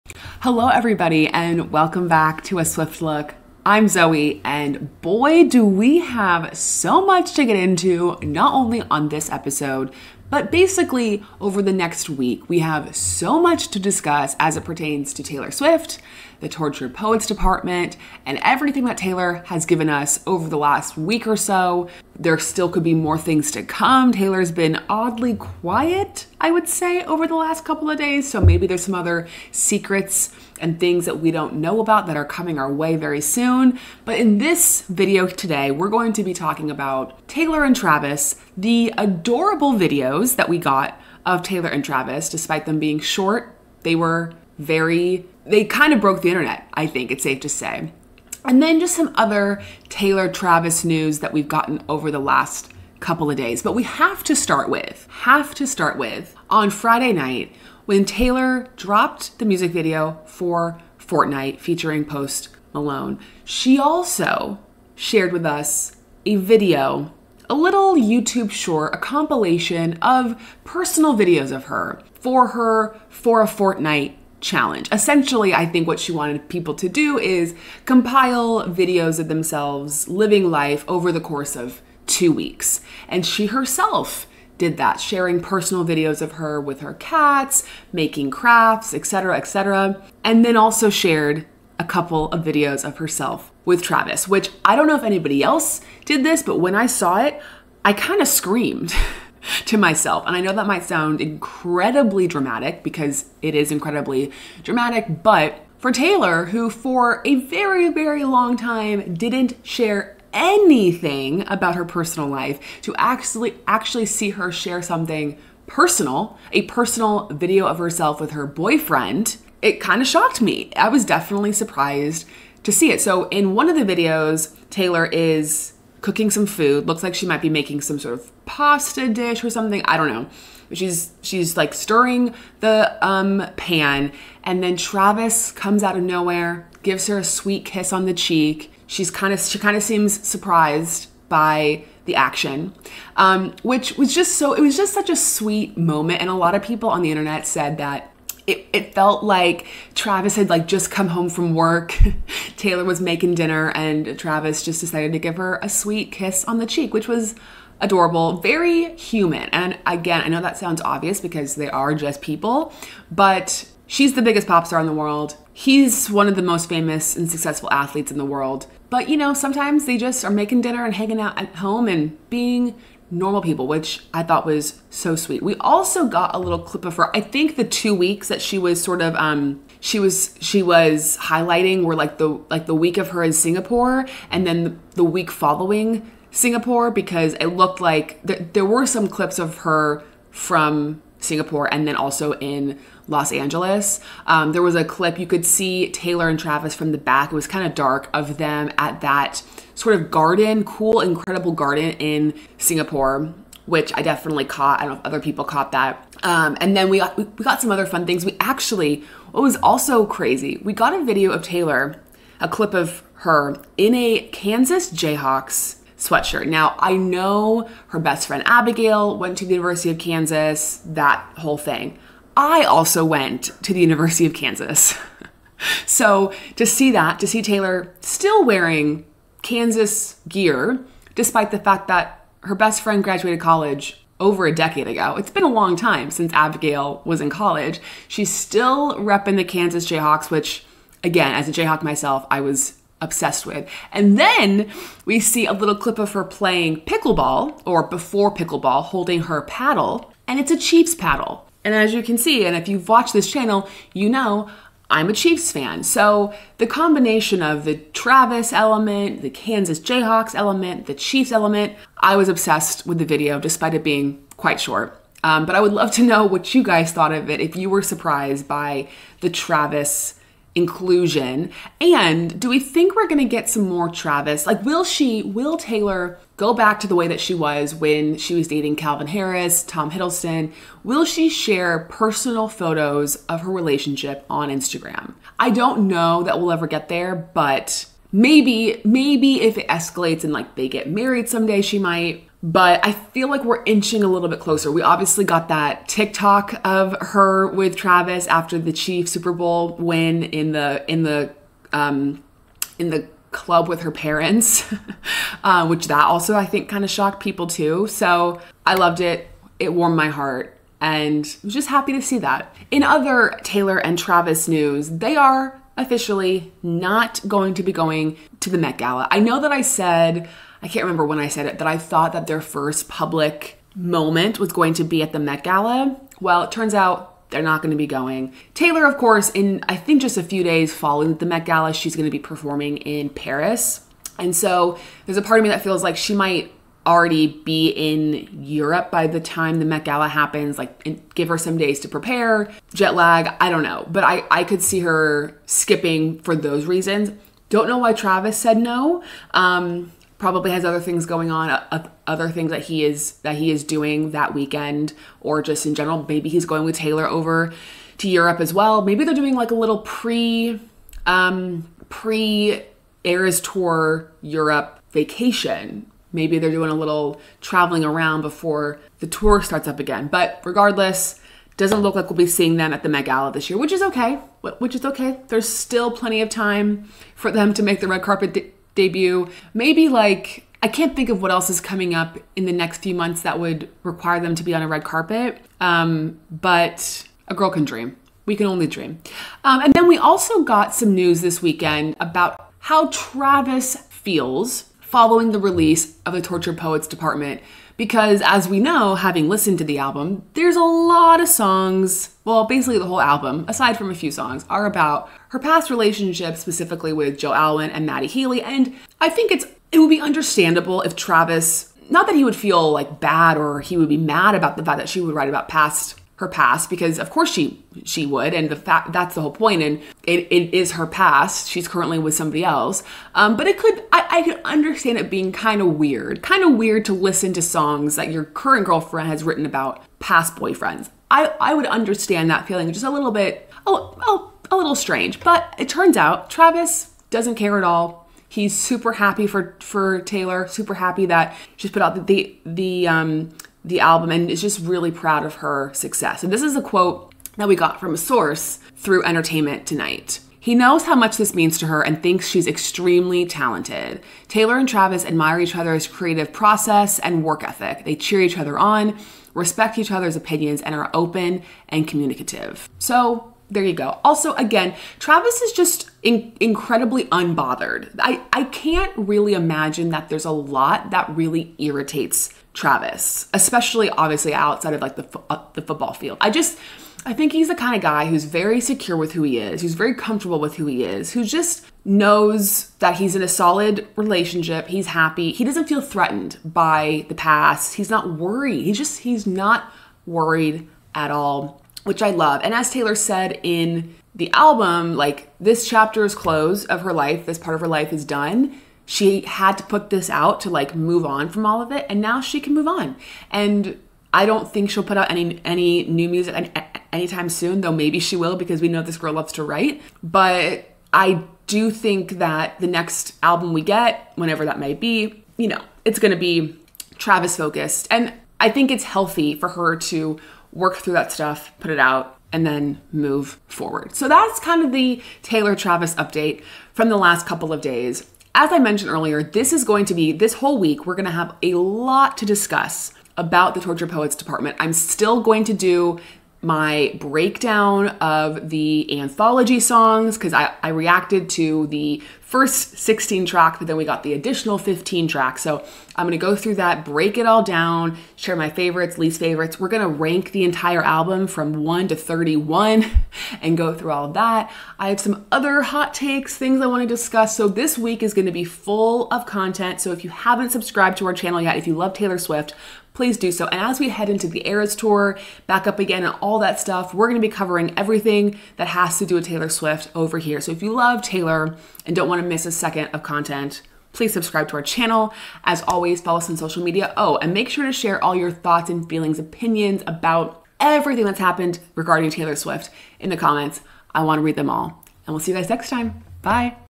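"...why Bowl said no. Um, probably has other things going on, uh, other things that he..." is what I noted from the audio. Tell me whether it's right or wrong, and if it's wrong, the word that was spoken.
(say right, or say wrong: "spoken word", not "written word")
wrong: "Travis", not "Bowl".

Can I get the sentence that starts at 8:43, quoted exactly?
So that's kind of the Taylor Travis update from the last couple of days.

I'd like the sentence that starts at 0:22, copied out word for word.
There still could be more things to come.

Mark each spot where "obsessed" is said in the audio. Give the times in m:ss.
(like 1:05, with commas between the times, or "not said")
4:02, 4:22.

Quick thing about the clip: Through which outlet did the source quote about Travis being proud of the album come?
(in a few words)
Entertainment Tonight.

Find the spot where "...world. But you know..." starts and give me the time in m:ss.
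2:48.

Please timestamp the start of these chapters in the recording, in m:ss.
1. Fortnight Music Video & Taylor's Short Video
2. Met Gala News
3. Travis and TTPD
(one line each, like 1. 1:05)
1. 0:54
2. 5:12
3. 6:30.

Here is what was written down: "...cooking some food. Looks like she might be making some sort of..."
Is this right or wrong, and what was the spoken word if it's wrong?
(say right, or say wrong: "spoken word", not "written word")
right.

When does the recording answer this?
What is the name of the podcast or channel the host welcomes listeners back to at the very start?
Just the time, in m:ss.
0:02.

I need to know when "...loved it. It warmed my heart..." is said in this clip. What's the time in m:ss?
5:08.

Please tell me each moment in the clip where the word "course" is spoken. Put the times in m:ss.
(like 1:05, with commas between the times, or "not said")
1:21, 5:28, 6:57.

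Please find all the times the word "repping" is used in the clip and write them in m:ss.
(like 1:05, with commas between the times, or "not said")
3:58.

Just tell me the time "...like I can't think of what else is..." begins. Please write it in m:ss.
6:19.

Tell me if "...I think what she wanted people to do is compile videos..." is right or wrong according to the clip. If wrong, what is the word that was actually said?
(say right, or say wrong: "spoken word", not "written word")
right.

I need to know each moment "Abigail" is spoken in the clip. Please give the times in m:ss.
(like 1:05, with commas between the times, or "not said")
3:38, 3:56.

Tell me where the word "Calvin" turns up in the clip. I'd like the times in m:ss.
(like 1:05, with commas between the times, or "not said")
4:38.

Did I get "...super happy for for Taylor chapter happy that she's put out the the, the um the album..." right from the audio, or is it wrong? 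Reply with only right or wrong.
wrong.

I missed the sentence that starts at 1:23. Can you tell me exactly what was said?
And she herself did that, sharing personal videos of her with her cats, making crafts, etc., etc.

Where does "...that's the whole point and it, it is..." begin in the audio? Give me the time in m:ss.
6:58.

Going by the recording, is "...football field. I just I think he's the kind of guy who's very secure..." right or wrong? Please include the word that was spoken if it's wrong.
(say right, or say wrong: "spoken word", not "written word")
right.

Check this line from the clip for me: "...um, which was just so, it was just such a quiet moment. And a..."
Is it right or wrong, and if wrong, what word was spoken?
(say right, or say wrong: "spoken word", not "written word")
wrong: "sweet", not "quiet".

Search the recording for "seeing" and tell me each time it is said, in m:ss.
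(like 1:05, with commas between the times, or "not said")
6:12.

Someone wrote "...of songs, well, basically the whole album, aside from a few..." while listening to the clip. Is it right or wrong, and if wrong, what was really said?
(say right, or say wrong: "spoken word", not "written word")
right.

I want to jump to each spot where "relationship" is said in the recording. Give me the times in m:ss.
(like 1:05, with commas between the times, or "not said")
4:43, 6:45, 8:03.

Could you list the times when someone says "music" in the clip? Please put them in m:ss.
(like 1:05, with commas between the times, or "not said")
0:59, 8:26.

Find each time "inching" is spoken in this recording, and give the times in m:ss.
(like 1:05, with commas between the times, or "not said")
4:53.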